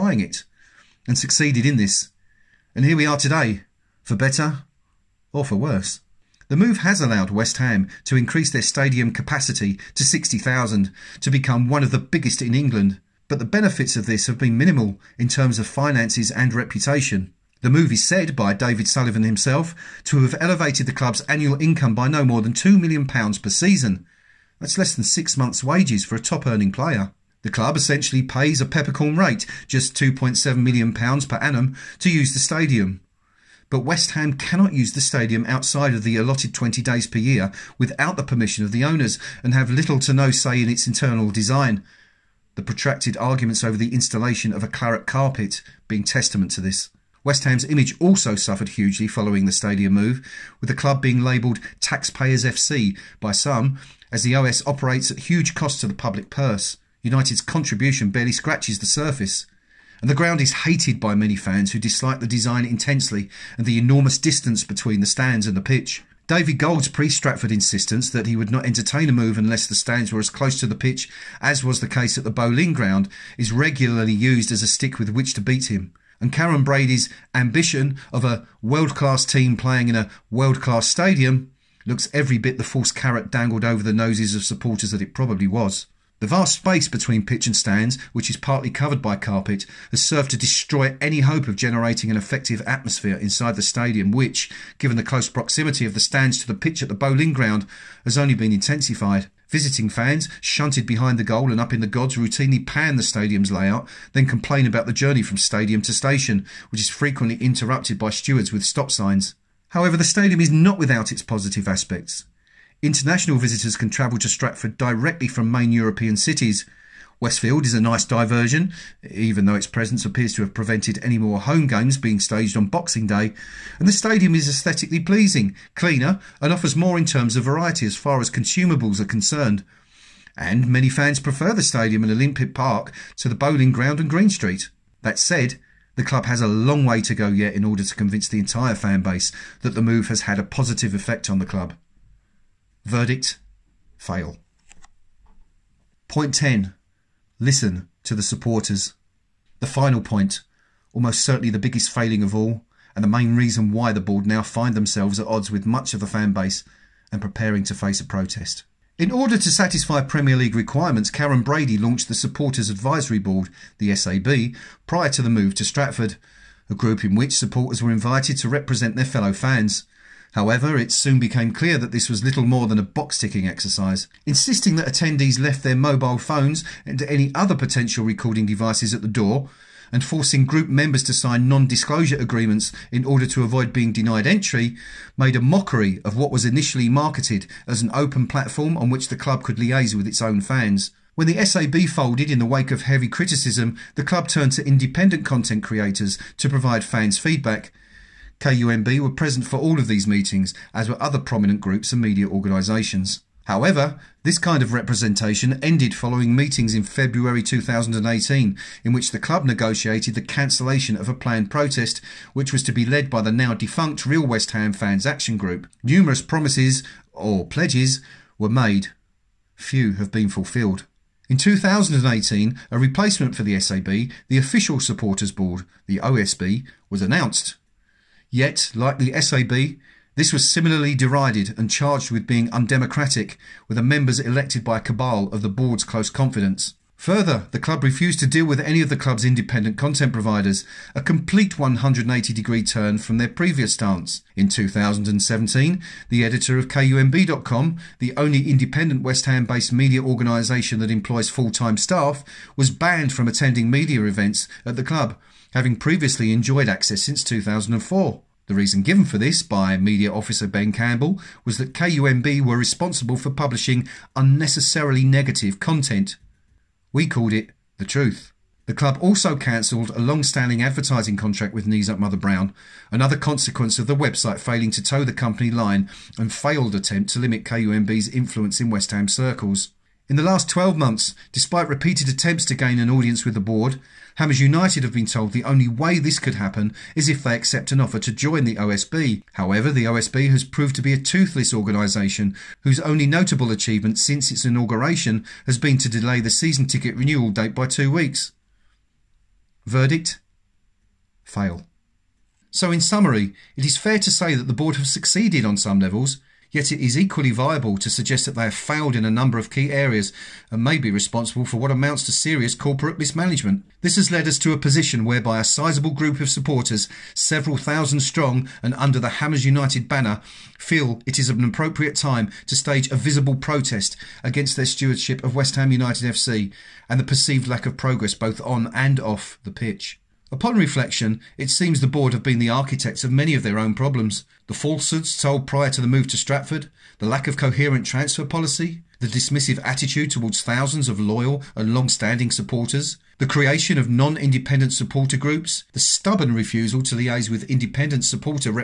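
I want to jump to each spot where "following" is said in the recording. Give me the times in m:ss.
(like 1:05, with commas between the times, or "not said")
0:49, 3:25.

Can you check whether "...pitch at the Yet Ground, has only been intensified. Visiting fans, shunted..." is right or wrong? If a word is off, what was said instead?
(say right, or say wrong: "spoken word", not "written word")
wrong: "Boleyn", not "Yet".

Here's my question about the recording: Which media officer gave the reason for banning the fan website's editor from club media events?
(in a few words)
Ben Campbell.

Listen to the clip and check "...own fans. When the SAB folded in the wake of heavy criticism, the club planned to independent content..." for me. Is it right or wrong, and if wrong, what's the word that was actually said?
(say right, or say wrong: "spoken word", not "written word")
wrong: "turned", not "planned".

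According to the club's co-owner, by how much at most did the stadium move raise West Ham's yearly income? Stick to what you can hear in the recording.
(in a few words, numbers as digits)
£2 million.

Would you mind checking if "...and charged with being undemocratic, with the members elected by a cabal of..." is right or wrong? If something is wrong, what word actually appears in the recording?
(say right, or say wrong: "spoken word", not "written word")
right.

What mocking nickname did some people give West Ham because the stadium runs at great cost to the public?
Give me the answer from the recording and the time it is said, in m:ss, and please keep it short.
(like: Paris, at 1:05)
Taxpayers FC, at 0:51.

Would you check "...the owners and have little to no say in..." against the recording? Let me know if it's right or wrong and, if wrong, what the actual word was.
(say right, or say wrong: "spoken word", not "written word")
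right.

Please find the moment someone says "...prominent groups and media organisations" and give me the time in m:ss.
3:21.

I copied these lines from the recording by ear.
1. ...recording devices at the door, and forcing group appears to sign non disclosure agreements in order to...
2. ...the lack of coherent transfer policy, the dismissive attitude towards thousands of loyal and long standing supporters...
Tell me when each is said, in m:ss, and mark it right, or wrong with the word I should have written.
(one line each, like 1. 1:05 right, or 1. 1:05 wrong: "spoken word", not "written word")
1. 2:58 wrong: "members", not "appears"
2. 5:36 right.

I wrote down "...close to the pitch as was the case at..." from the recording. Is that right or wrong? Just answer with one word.
right.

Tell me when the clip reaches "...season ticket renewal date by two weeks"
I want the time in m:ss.
4:56.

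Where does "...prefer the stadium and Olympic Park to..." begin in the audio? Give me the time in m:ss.
2:11.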